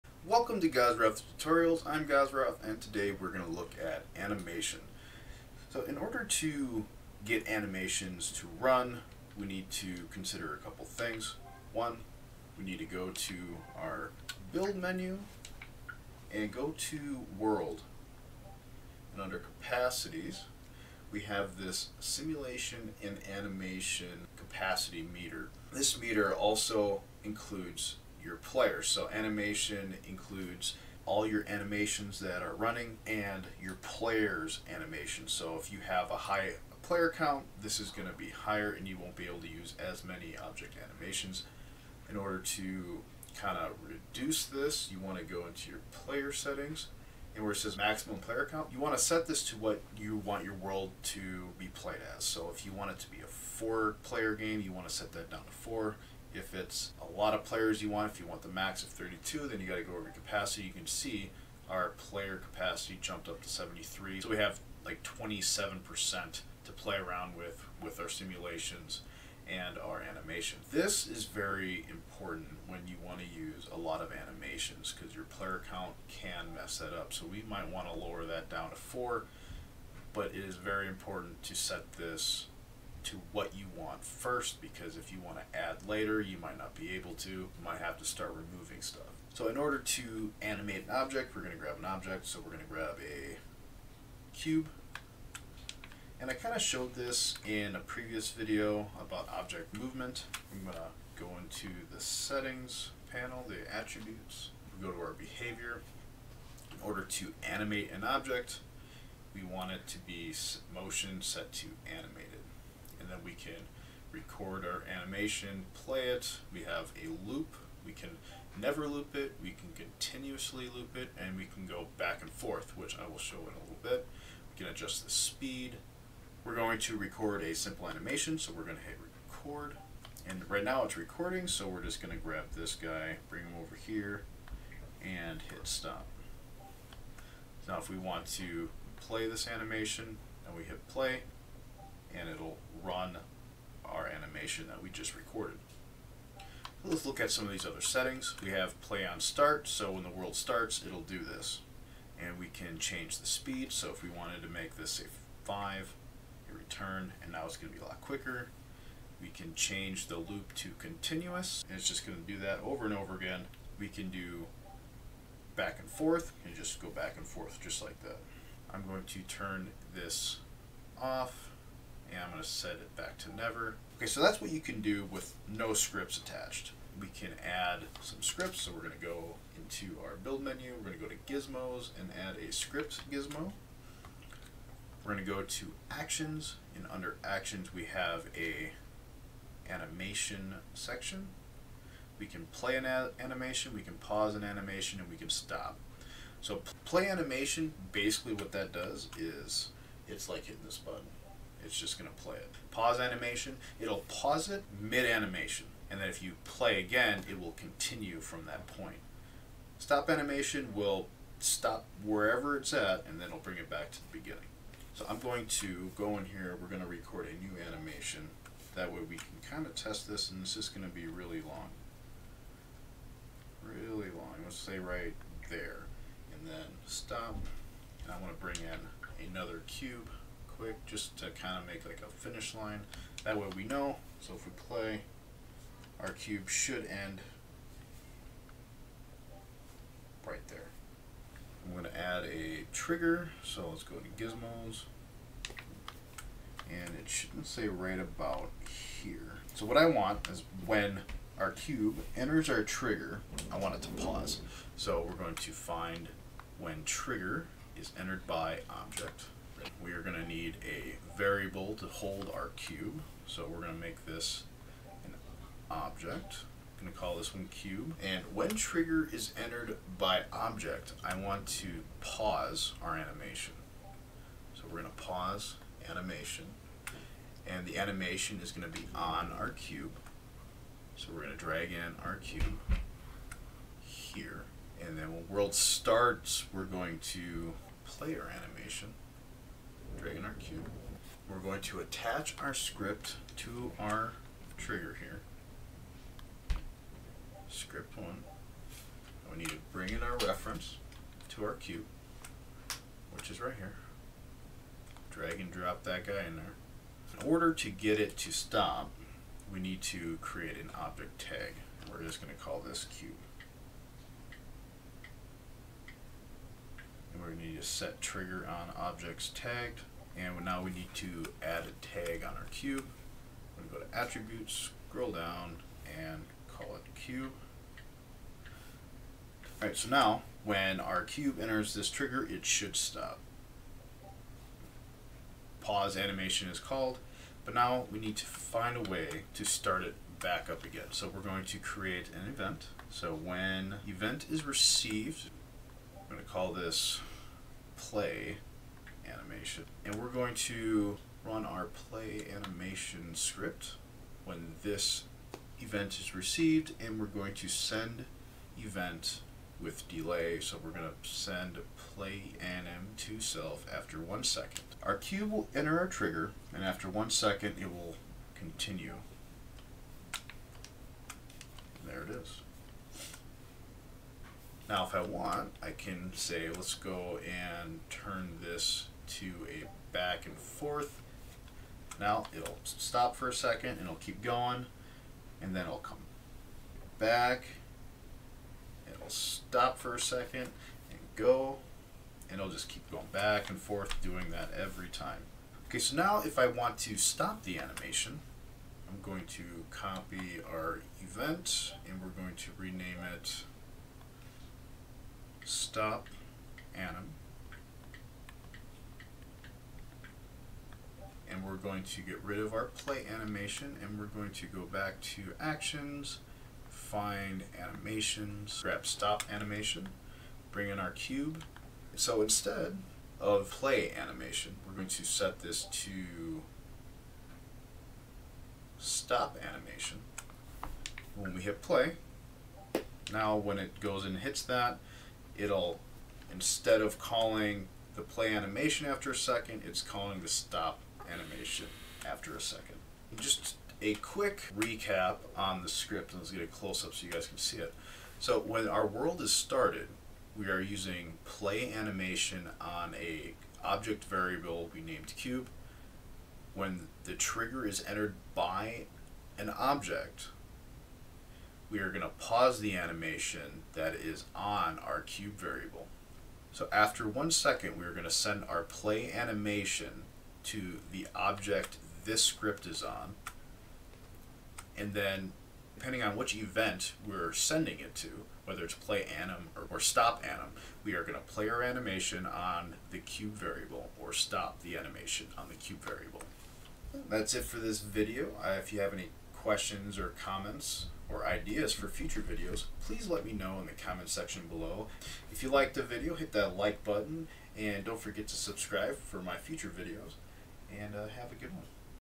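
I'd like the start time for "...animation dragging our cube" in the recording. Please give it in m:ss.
4:48.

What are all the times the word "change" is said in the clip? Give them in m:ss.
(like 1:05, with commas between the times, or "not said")
2:32, 2:39.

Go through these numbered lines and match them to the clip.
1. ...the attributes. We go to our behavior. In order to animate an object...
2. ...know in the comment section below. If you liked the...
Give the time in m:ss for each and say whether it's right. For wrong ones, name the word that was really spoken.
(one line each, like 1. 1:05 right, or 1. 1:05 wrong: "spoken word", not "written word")
1. 1:43 right
2. 8:13 right.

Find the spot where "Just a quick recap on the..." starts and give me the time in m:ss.
7:23.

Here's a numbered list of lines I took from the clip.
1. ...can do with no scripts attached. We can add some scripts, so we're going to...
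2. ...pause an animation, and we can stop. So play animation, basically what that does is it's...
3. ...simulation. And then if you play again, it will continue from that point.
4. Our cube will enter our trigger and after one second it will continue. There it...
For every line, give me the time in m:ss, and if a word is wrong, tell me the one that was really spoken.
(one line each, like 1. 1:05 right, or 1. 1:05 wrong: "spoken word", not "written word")
1. 2:54 right
2. 3:13 right
3. 3:25 wrong: "animation", not "simulation"
4. 6:04 right.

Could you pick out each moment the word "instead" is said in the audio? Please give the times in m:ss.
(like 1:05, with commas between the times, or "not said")
7:02, 7:16.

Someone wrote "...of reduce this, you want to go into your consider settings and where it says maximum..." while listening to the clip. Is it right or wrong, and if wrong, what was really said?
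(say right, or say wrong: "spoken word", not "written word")
wrong: "player", not "consider".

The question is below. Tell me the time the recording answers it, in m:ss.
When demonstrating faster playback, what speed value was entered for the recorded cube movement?
2:35.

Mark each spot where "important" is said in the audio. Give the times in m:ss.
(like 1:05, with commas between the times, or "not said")
1:11, 1:20.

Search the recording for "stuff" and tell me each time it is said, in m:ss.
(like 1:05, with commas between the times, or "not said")
1:28.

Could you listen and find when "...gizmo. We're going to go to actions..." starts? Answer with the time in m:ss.
3:03.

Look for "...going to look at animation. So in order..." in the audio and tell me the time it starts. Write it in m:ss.
0:03.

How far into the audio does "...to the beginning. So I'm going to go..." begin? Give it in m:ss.
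3:33.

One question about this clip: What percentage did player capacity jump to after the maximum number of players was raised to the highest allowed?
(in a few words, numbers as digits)
73.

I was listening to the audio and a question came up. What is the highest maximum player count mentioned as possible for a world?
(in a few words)
32.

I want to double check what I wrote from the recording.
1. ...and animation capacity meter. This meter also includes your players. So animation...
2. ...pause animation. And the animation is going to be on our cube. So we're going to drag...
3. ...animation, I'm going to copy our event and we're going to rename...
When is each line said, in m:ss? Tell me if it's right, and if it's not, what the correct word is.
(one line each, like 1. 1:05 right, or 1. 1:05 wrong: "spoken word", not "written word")
1. 0:23 right
2. 4:35 right
3. 6:37 right.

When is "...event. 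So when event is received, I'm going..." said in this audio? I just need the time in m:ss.
5:42.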